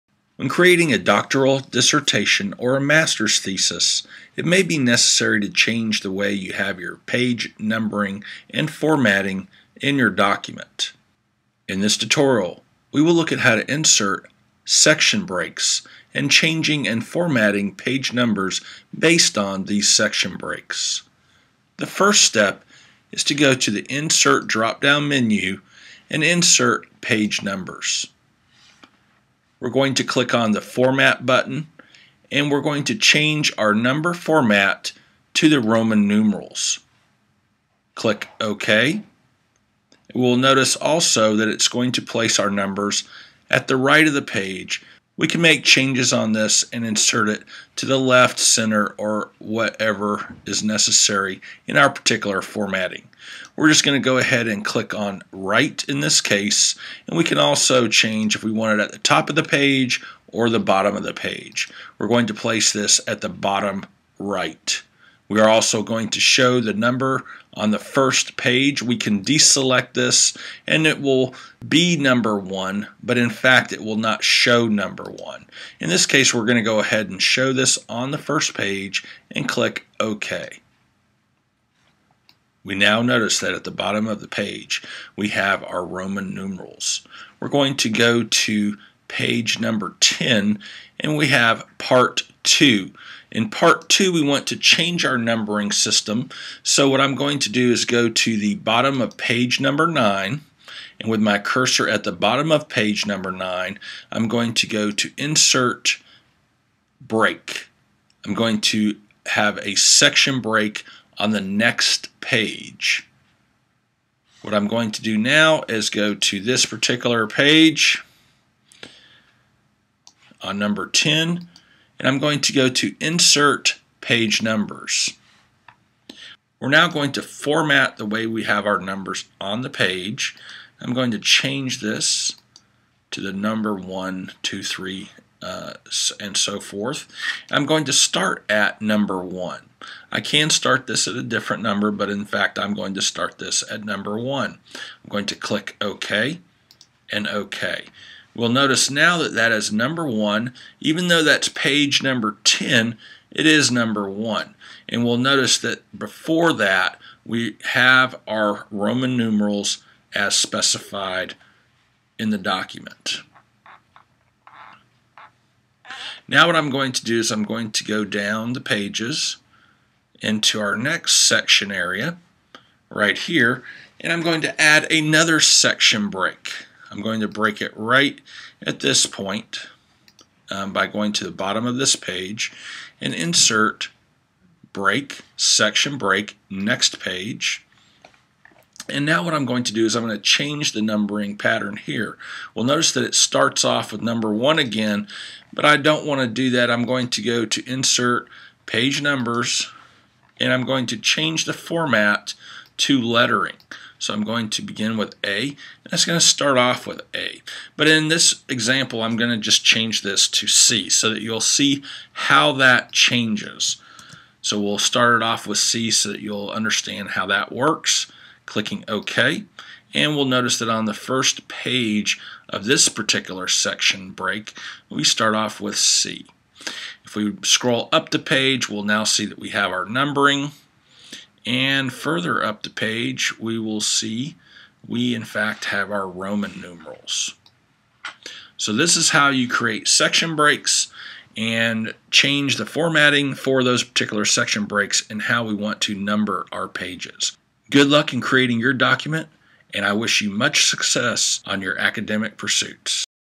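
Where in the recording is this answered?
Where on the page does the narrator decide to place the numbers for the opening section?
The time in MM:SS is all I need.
01:03.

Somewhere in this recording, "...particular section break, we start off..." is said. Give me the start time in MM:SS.
03:42.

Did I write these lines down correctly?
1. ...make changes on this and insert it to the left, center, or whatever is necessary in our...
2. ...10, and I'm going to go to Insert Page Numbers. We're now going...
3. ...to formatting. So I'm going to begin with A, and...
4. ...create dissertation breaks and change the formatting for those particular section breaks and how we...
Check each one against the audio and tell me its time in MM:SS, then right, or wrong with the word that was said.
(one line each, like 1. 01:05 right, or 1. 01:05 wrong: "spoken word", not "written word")
1. 00:45 right
2. 02:00 right
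3. 03:22 wrong: "lettering", not "formatting"
4. 03:59 wrong: "section", not "dissertation".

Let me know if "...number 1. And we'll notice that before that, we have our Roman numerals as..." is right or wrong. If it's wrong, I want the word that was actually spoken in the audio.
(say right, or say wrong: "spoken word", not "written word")
right.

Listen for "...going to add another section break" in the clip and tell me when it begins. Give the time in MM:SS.
02:54.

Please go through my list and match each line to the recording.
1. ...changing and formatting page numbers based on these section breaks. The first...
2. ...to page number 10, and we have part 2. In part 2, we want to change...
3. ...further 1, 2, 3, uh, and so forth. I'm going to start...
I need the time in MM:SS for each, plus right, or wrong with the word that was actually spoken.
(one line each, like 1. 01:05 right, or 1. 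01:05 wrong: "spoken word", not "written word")
1. 00:16 right
2. 01:28 right
3. 02:13 wrong: "number", not "further".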